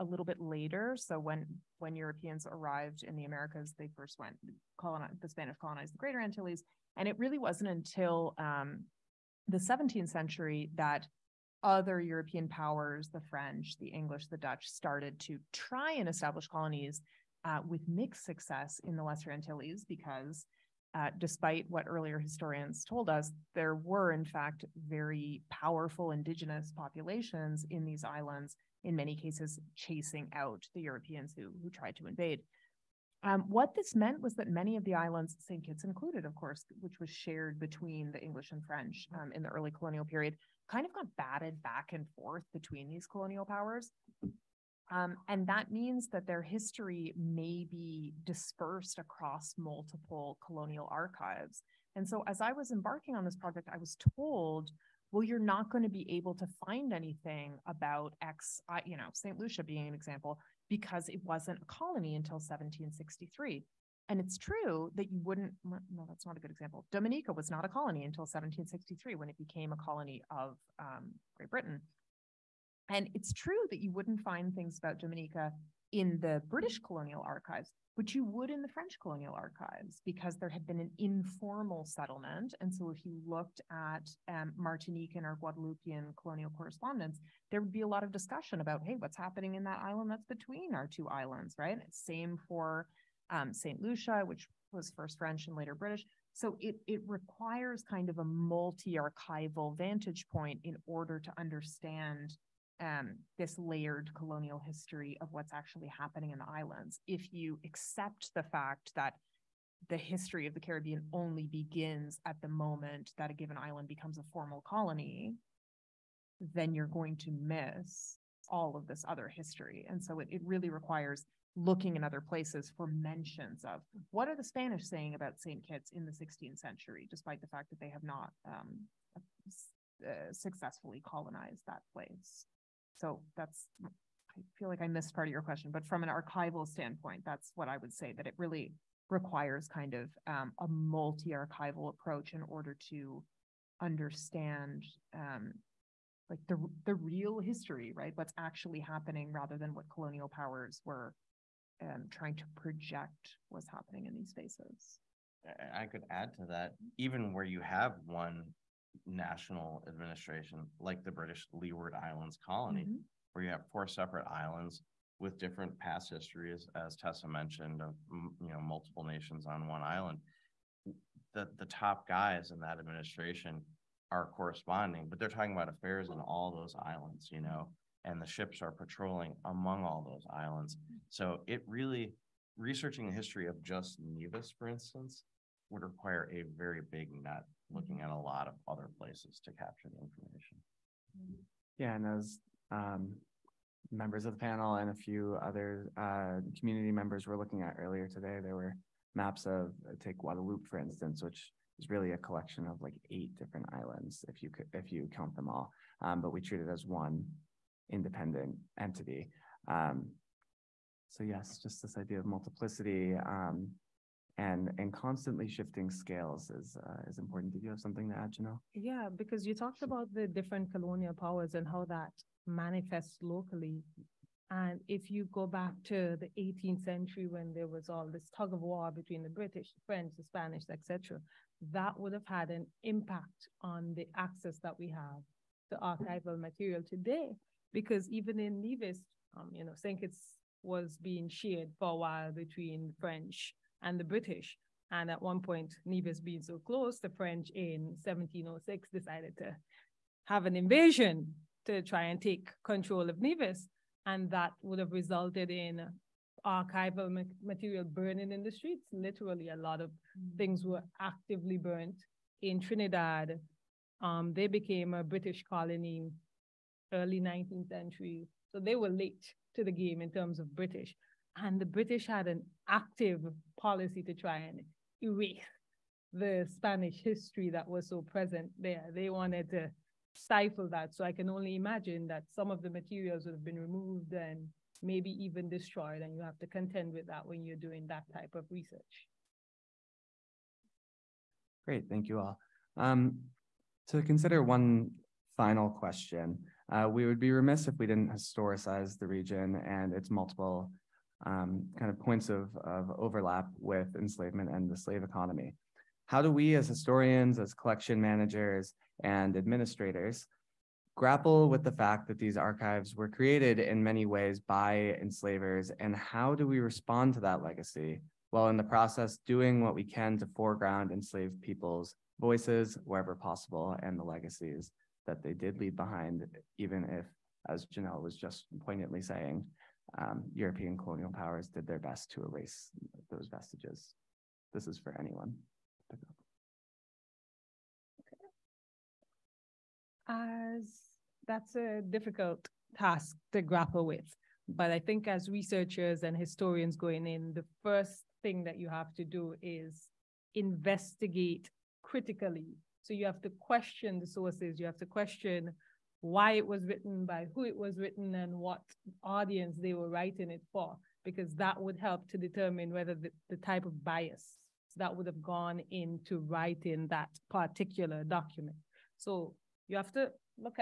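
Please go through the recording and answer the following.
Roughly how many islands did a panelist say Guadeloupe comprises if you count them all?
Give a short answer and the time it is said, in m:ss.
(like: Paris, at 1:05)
8, at 3:23.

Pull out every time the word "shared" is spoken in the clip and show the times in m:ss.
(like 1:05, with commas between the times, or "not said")
0:37, 4:01.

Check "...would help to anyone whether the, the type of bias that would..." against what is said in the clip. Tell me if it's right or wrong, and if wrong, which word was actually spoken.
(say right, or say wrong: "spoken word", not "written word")
wrong: "determine", not "anyone".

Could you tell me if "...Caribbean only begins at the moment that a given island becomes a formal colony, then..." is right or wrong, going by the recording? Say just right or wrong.
right.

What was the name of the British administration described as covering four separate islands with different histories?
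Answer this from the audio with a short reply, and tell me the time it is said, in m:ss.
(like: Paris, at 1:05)
British Leeward Islands, at 2:41.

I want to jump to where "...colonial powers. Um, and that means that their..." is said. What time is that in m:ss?
0:43.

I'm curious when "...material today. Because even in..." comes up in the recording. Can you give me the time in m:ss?
3:56.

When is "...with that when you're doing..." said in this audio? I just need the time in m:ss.
4:46.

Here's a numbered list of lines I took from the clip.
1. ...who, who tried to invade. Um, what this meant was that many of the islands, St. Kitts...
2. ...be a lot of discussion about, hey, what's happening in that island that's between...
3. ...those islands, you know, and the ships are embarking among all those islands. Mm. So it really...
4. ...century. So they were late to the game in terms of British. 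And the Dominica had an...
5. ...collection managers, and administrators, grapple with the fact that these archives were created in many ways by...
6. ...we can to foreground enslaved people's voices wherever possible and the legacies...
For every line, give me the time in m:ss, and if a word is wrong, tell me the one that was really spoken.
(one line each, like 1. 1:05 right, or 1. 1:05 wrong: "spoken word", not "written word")
1. 0:31 right
2. 1:27 right
3. 2:56 wrong: "patrolling", not "embarking"
4. 4:27 wrong: "British", not "Dominica"
5. 5:07 right
6. 5:19 right.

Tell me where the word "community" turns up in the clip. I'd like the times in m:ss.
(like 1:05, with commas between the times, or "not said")
3:16.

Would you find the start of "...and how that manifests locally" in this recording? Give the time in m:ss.
3:41.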